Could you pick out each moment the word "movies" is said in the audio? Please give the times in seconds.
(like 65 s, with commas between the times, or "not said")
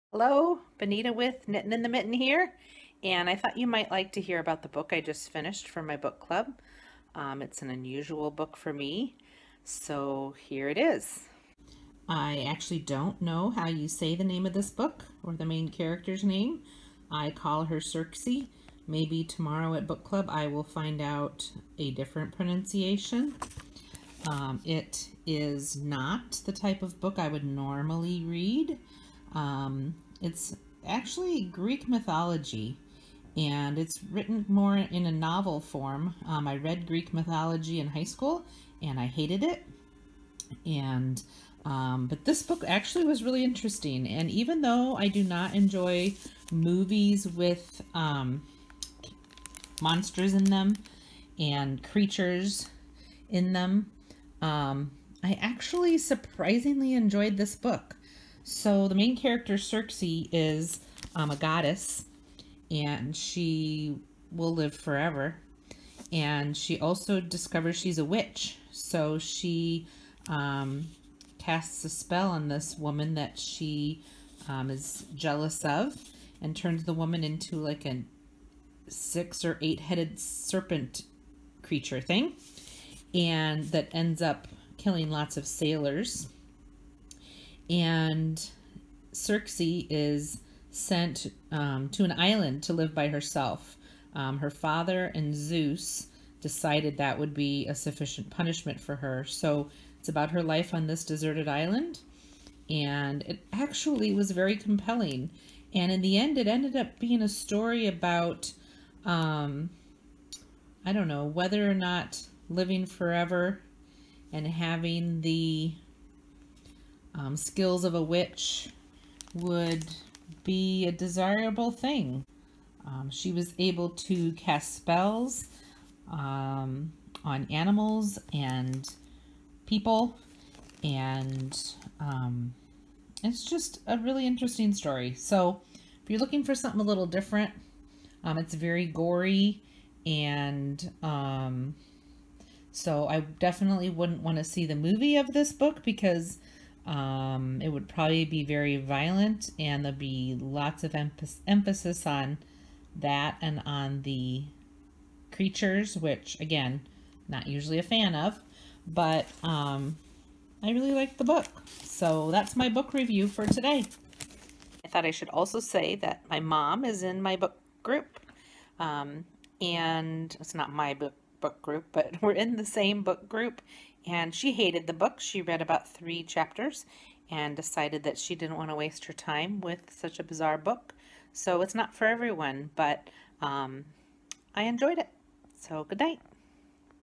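46 s, 144 s.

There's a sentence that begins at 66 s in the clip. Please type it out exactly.
And she also discovers she's a witch.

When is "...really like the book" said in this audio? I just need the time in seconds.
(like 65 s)
160 s.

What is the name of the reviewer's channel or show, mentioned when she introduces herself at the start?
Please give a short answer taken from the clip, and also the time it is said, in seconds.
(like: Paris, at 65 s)
Knitting in the Mitten, at 1 s.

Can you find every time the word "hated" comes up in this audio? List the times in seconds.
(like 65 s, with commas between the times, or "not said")
39 s, 174 s.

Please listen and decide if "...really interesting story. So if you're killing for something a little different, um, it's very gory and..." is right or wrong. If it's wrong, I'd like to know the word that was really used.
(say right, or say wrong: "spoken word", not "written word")
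wrong: "looking", not "killing".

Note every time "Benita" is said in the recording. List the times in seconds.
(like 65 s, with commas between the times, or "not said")
0 s.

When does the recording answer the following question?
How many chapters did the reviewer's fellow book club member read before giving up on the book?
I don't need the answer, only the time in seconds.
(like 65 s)
175 s.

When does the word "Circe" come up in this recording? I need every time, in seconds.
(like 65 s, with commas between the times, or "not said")
17 s, 59 s, 89 s.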